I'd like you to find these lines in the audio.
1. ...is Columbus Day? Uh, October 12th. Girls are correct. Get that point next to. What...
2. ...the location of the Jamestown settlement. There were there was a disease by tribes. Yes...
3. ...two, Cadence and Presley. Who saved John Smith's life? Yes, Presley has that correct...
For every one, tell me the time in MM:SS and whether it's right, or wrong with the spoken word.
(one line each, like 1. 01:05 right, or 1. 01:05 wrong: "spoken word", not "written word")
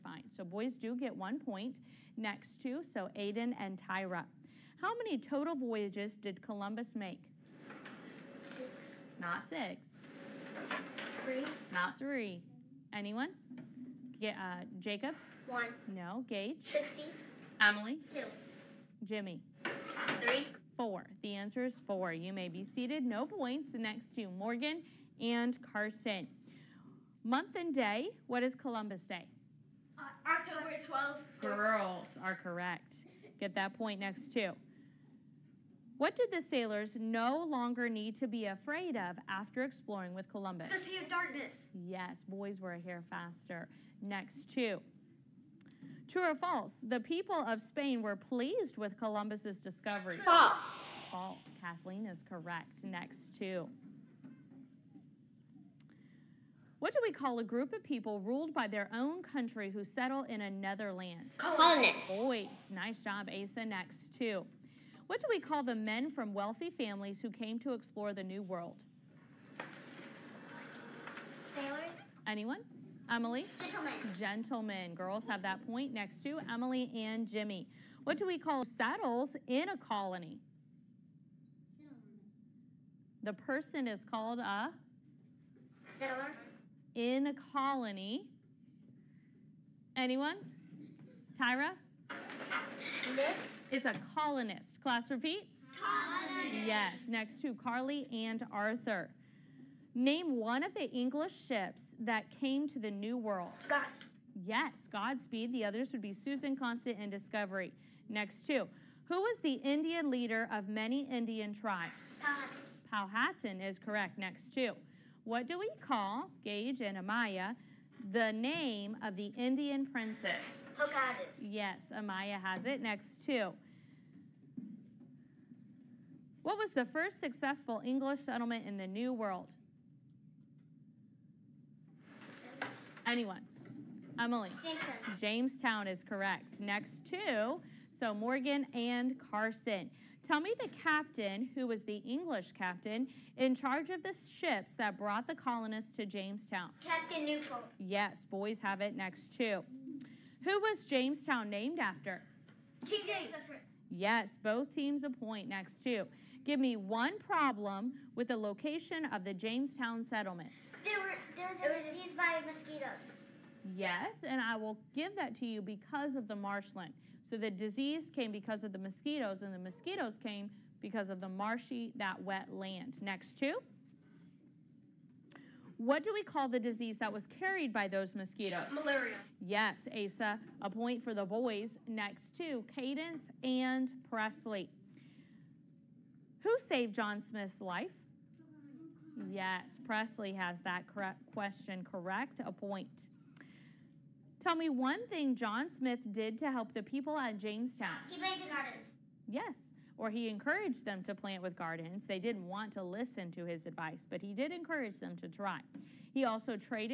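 1. 00:28 right
2. 02:38 wrong: "mosquitoes", not "tribes"
3. 03:02 right.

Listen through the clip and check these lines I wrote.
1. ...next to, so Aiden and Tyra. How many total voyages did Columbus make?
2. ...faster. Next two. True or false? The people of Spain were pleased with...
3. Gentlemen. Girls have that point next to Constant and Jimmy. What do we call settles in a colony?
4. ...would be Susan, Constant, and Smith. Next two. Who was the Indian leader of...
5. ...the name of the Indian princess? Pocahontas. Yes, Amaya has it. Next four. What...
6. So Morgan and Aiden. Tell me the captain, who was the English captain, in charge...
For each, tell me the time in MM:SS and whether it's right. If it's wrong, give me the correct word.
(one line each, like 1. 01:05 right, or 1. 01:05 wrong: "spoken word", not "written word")
1. 00:02 right
2. 00:43 right
3. 01:14 wrong: "Emily", not "Constant"
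4. 01:45 wrong: "Discovery", not "Smith"
5. 01:58 wrong: "two", not "four"
6. 02:17 wrong: "Carson", not "Aiden".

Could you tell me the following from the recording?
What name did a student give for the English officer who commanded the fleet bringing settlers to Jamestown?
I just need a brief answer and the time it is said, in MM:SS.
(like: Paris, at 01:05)
Captain Newport, at 02:26.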